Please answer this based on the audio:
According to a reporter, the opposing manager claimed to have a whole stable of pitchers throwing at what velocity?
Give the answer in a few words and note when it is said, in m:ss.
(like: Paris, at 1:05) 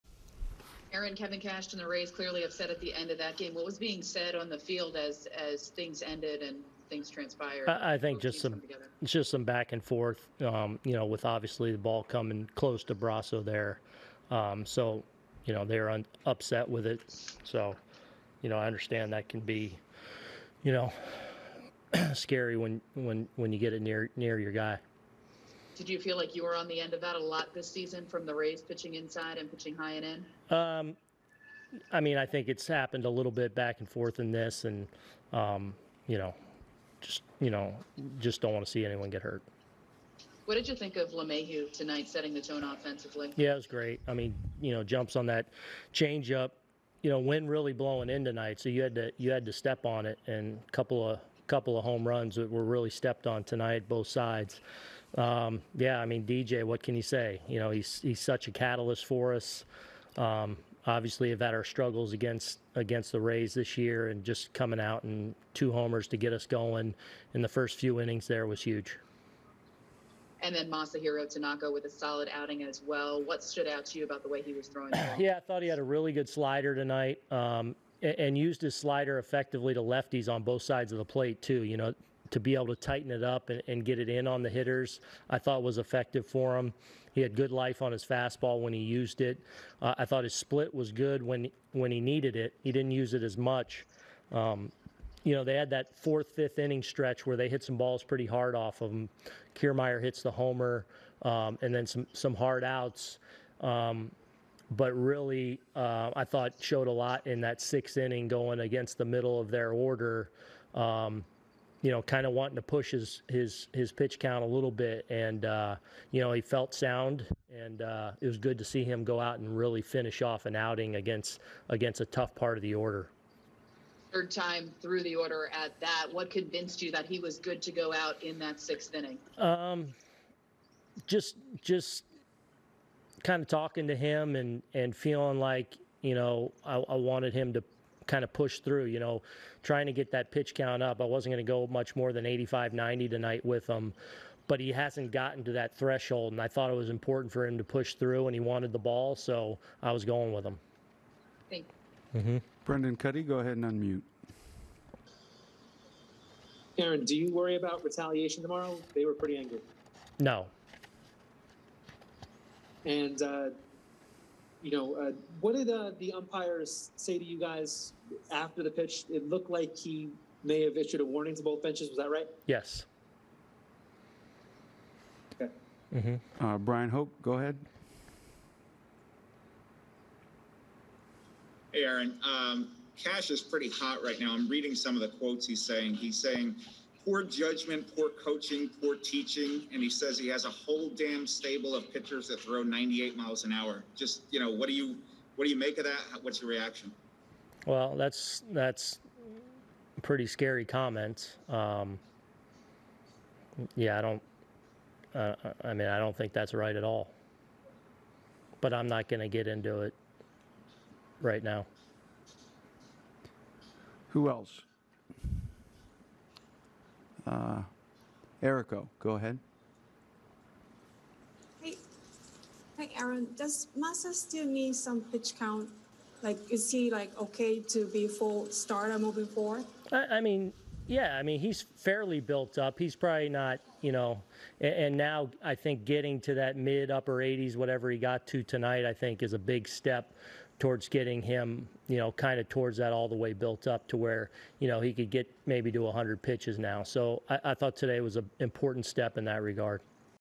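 98 miles an hour, at 3:12.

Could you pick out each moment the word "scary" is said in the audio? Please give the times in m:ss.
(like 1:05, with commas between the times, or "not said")
0:22, 3:20.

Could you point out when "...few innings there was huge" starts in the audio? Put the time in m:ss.
1:07.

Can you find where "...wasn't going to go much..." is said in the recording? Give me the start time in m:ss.
2:21.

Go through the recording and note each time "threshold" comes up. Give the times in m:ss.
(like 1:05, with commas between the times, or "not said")
2:25.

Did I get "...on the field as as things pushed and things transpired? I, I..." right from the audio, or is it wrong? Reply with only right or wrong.
wrong.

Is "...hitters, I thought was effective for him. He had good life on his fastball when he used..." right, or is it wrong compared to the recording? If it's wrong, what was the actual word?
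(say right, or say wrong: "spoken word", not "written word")
right.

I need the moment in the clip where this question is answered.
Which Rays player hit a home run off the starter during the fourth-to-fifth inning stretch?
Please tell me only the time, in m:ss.
1:39.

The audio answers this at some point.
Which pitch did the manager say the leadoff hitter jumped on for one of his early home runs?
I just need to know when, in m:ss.
0:45.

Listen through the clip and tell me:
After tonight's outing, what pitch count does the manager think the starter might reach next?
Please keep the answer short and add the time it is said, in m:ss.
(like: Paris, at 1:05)
100 pitches, at 4:05.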